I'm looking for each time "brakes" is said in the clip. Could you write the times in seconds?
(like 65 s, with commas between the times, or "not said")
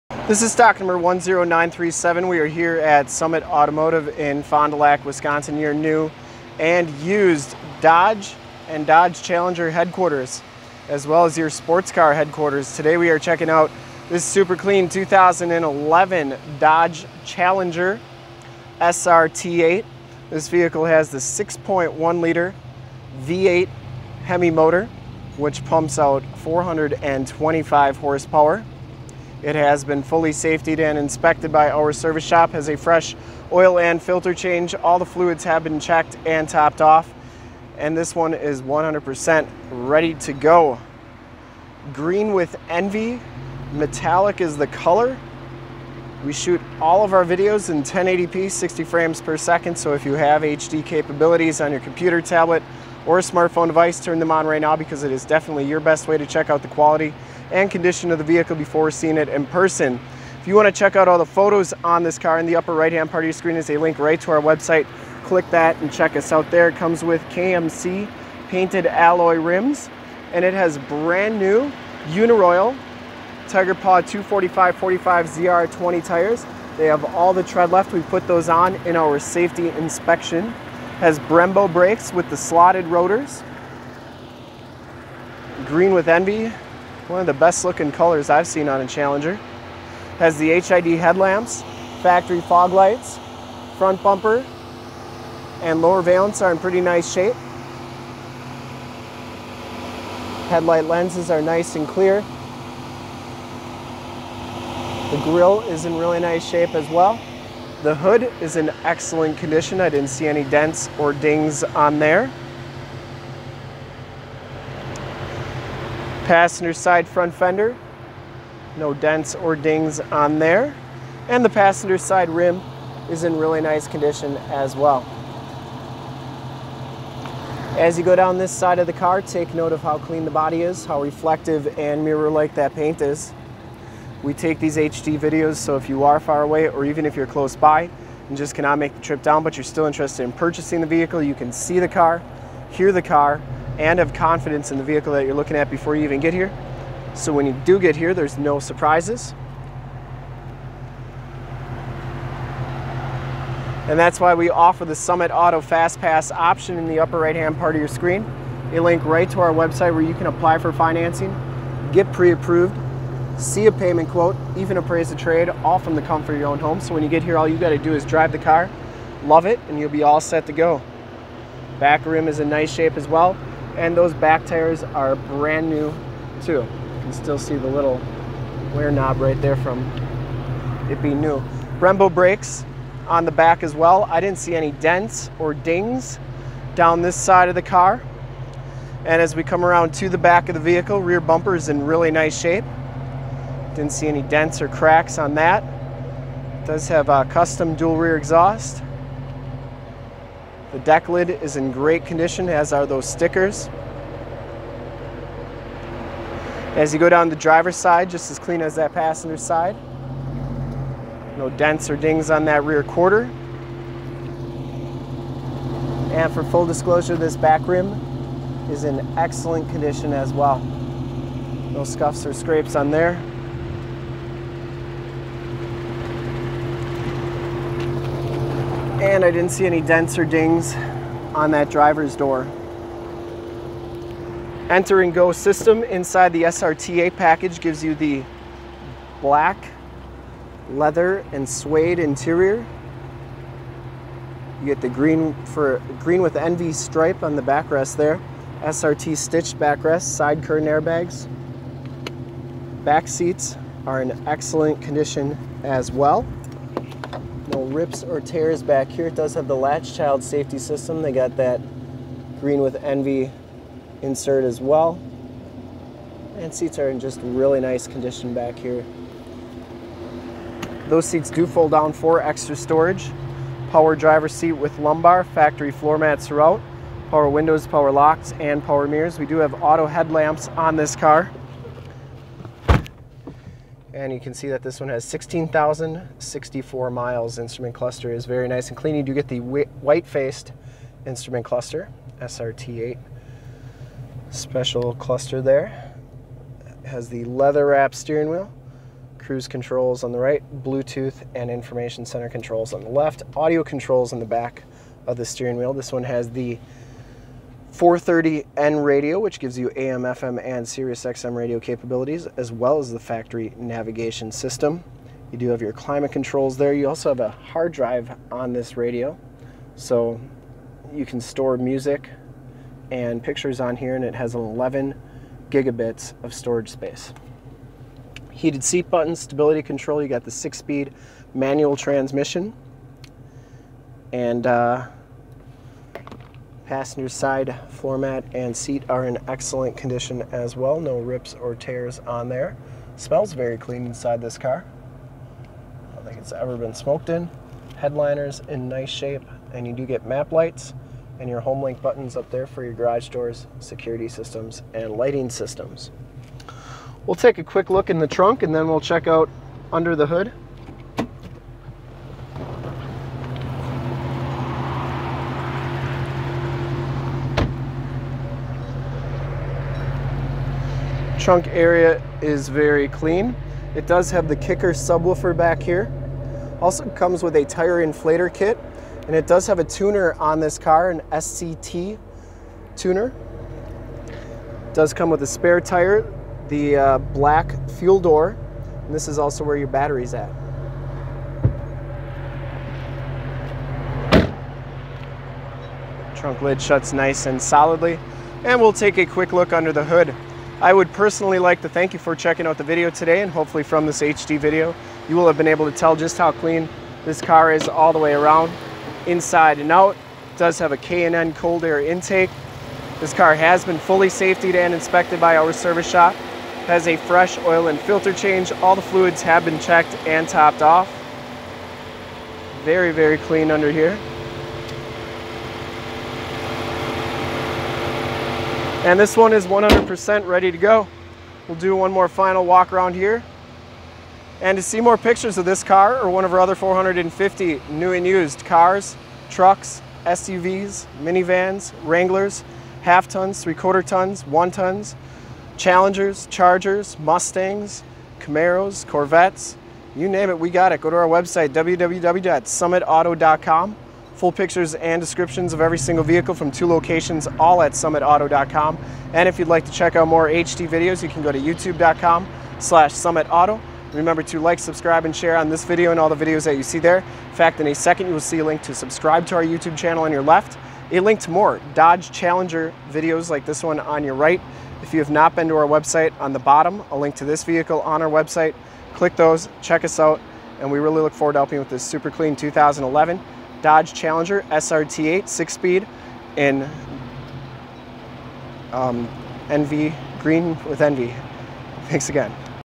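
81 s, 182 s.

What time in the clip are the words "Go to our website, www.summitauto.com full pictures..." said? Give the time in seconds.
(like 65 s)
450 s.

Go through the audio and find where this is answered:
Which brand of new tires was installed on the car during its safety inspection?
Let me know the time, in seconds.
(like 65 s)
72 s.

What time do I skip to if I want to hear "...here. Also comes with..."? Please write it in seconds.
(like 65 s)
375 s.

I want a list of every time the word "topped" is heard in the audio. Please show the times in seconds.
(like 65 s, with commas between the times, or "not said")
36 s, 420 s.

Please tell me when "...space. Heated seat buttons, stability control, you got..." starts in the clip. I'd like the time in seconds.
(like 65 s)
326 s.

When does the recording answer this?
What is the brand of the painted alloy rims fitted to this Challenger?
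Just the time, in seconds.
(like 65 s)
67 s.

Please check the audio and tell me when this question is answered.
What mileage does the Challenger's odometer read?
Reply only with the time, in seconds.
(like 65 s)
285 s.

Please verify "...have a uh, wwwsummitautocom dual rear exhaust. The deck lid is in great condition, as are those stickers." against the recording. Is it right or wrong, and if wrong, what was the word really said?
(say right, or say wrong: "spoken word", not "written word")
wrong: "custom", not "wwwsummitautocom".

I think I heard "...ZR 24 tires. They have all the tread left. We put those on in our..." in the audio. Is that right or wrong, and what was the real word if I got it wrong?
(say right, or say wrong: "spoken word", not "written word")
wrong: "20", not "24".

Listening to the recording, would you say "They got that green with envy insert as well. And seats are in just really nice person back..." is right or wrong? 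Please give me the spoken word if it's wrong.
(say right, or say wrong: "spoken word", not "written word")
wrong: "condition", not "person".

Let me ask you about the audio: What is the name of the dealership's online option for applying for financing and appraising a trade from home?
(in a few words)
Summit Auto Fast Pass.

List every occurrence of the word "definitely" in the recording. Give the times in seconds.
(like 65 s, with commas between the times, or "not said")
55 s.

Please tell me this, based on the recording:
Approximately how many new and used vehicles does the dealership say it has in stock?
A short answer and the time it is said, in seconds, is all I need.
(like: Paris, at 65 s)
450, at 436 s.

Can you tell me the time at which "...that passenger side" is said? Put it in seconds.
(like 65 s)
208 s.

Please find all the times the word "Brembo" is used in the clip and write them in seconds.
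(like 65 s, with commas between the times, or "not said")
81 s, 181 s.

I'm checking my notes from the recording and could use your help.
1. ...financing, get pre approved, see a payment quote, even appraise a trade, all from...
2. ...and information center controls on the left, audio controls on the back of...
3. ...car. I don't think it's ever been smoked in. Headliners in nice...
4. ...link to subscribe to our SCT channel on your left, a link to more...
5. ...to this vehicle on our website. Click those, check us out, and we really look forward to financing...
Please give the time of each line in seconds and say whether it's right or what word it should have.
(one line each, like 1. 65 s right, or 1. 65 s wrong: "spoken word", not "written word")
1. 160 s right
2. 301 s right
3. 344 s right
4. 468 s wrong: "YouTube", not "SCT"
5. 477 s wrong: "helping", not "financing".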